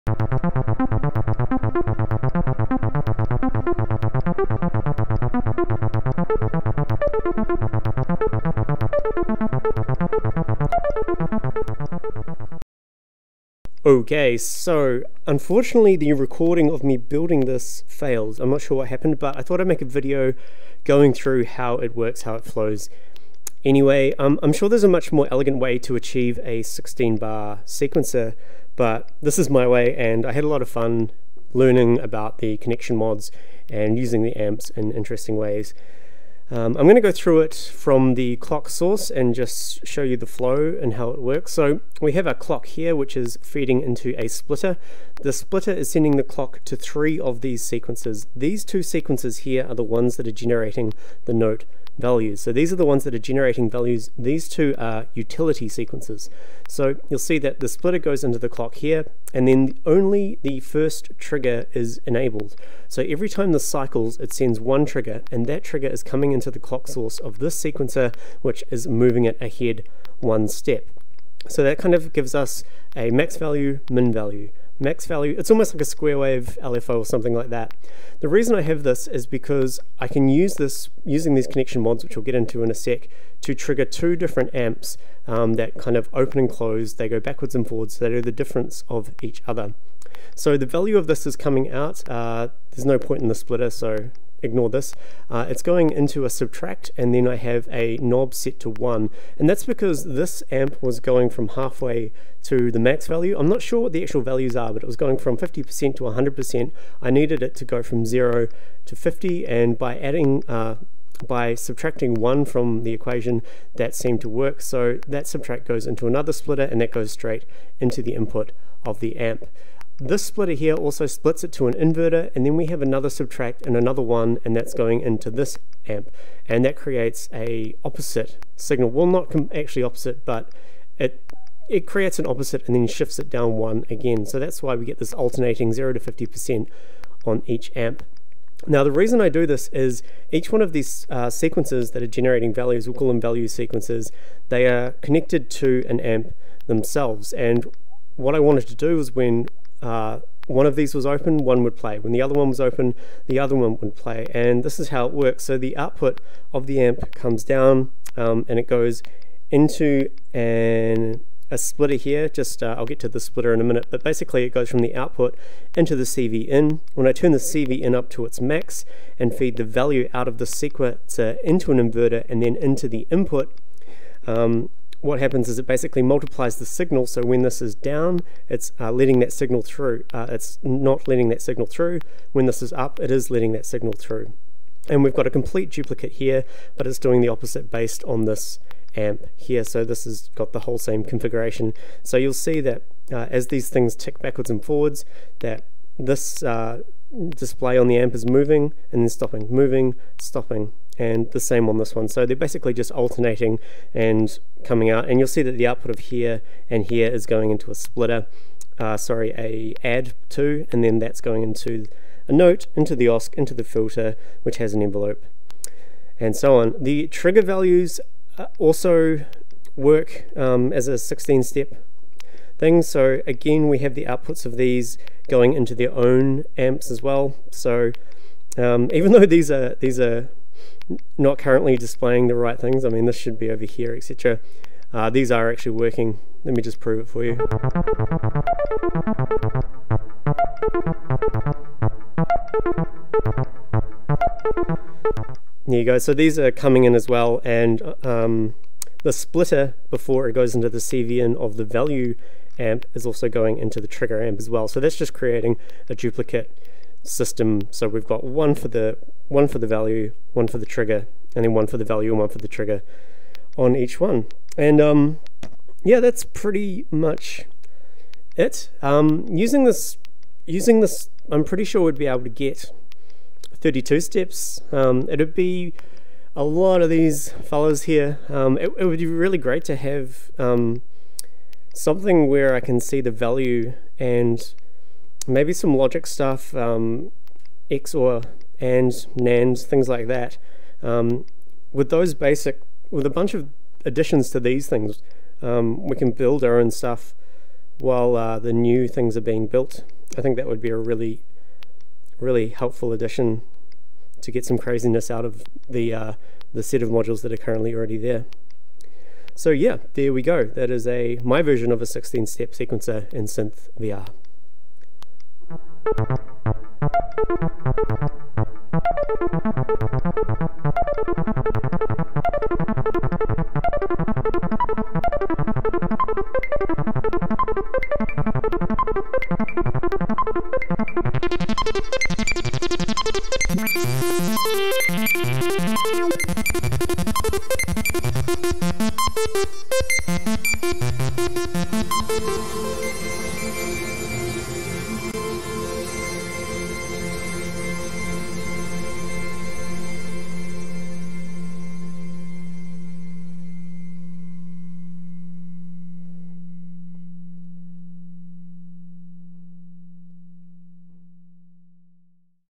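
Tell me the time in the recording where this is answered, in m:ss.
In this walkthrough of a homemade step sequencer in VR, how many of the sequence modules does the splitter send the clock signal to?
0:46.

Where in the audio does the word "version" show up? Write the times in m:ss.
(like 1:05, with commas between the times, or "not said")
5:11.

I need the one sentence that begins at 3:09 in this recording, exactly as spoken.
So this has got the whole same configuration.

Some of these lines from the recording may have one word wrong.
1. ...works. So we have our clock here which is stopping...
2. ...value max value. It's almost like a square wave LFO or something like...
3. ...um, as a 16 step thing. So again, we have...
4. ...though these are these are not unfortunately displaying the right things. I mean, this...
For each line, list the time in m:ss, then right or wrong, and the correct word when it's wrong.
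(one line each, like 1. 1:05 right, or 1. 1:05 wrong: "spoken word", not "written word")
1. 0:41 wrong: "feeding", not "stopping"
2. 1:14 right
3. 3:40 right
4. 3:49 wrong: "currently", not "unfortunately".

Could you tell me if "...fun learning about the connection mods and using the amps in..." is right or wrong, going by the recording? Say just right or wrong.
right.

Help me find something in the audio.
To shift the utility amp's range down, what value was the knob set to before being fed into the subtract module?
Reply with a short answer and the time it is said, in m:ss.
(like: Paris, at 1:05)
1, at 1:38.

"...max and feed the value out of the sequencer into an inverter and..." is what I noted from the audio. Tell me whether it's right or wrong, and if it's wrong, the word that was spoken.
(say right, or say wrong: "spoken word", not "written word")
right.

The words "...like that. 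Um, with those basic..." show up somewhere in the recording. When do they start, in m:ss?
4:49.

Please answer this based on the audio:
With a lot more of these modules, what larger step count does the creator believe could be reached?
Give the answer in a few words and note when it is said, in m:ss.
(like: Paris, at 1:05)
32, at 4:33.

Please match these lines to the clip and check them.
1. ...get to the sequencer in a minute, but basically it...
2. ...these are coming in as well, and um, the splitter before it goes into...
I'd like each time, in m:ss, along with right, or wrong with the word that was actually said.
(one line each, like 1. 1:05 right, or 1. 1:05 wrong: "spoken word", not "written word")
1. 2:42 wrong: "splitter", not "sequencer"
2. 4:06 right.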